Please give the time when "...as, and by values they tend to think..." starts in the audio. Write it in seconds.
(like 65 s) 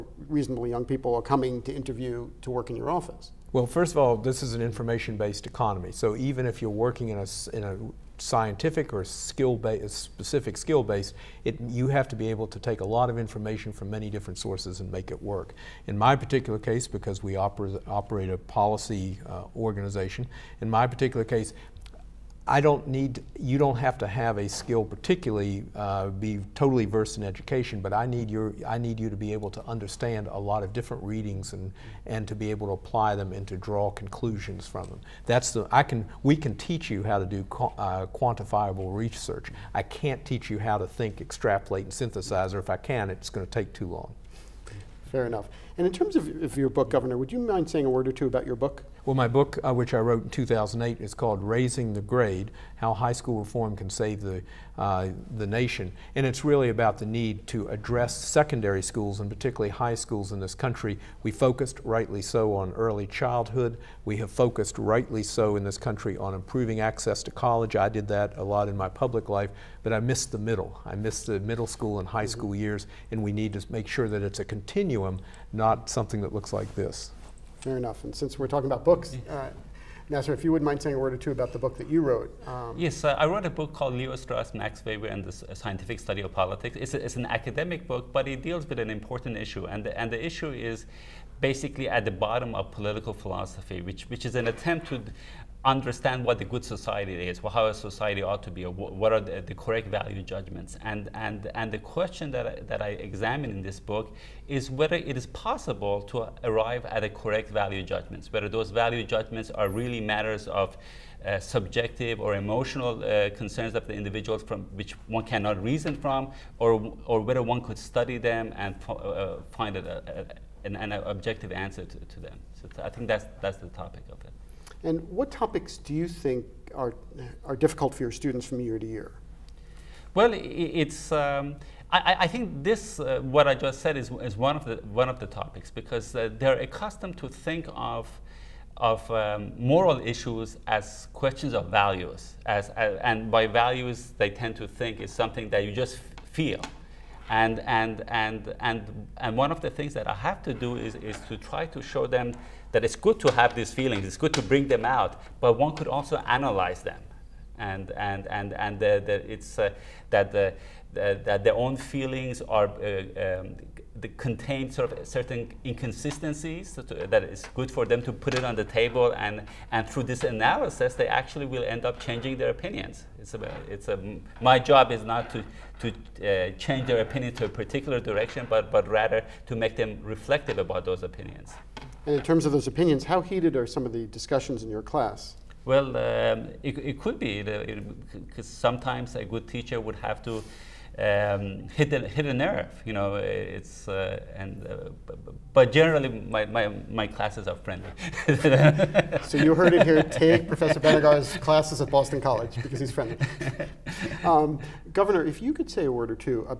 142 s.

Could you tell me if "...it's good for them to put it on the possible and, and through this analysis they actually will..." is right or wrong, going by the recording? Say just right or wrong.
wrong.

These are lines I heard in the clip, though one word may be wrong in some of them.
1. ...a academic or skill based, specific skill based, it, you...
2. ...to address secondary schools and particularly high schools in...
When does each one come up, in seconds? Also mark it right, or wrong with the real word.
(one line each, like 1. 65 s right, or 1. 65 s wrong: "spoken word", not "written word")
1. 7 s wrong: "scientific", not "academic"
2. 57 s right.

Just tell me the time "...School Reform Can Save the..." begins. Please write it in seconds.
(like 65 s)
53 s.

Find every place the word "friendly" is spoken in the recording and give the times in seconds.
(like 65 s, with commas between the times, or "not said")
197 s, 202 s.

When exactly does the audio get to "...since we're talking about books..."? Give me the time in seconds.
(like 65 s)
78 s.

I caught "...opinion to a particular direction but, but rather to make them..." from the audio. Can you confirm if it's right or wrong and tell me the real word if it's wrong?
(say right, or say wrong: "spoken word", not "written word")
right.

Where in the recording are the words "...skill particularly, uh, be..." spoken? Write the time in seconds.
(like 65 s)
24 s.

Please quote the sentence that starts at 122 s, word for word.
So I think that's, that's the topic of it.